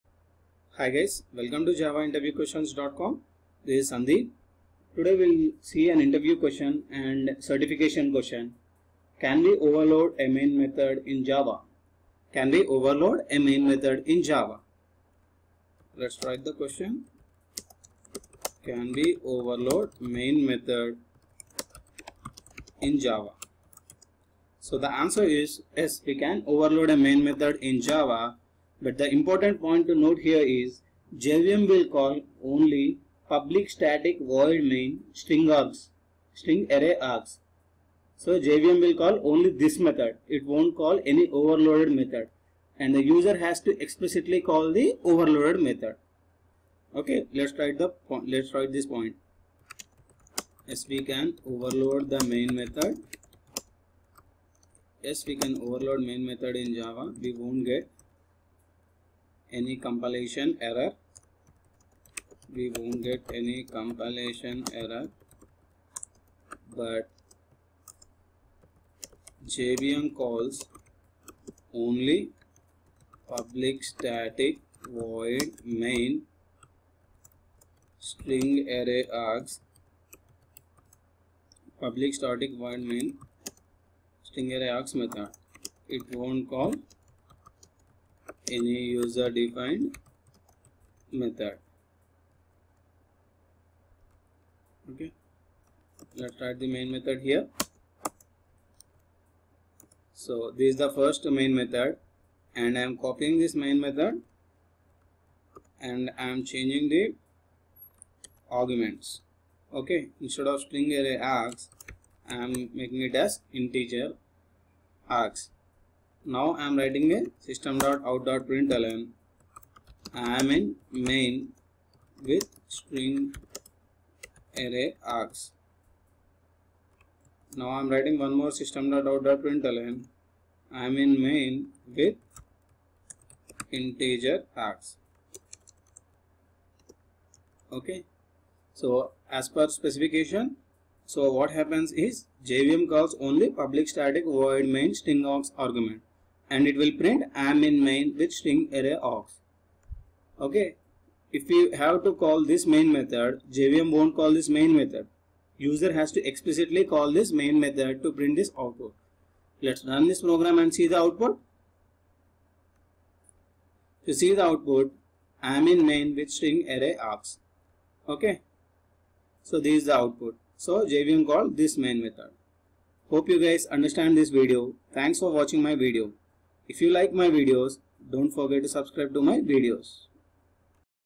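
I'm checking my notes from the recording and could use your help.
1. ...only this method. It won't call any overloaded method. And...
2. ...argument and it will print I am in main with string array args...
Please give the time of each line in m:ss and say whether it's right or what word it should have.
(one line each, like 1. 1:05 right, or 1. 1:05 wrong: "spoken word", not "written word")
1. 0:39 right
2. 2:25 right.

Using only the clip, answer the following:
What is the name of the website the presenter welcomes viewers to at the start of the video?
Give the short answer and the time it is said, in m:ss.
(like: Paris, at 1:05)
javainterviewquestions.com, at 0:01.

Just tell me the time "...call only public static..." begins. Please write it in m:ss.
0:31.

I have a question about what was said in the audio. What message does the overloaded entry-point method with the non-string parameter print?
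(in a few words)
I am in main with integer args.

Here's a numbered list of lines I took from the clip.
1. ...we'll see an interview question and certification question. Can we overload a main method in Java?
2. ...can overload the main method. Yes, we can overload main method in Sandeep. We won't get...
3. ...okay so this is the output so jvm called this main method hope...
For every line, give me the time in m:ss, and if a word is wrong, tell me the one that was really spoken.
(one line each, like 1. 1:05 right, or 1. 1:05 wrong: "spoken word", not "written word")
1. 0:05 right
2. 0:51 wrong: "Java", not "Sandeep"
3. 2:48 right.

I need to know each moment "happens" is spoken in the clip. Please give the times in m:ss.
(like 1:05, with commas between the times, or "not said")
2:21.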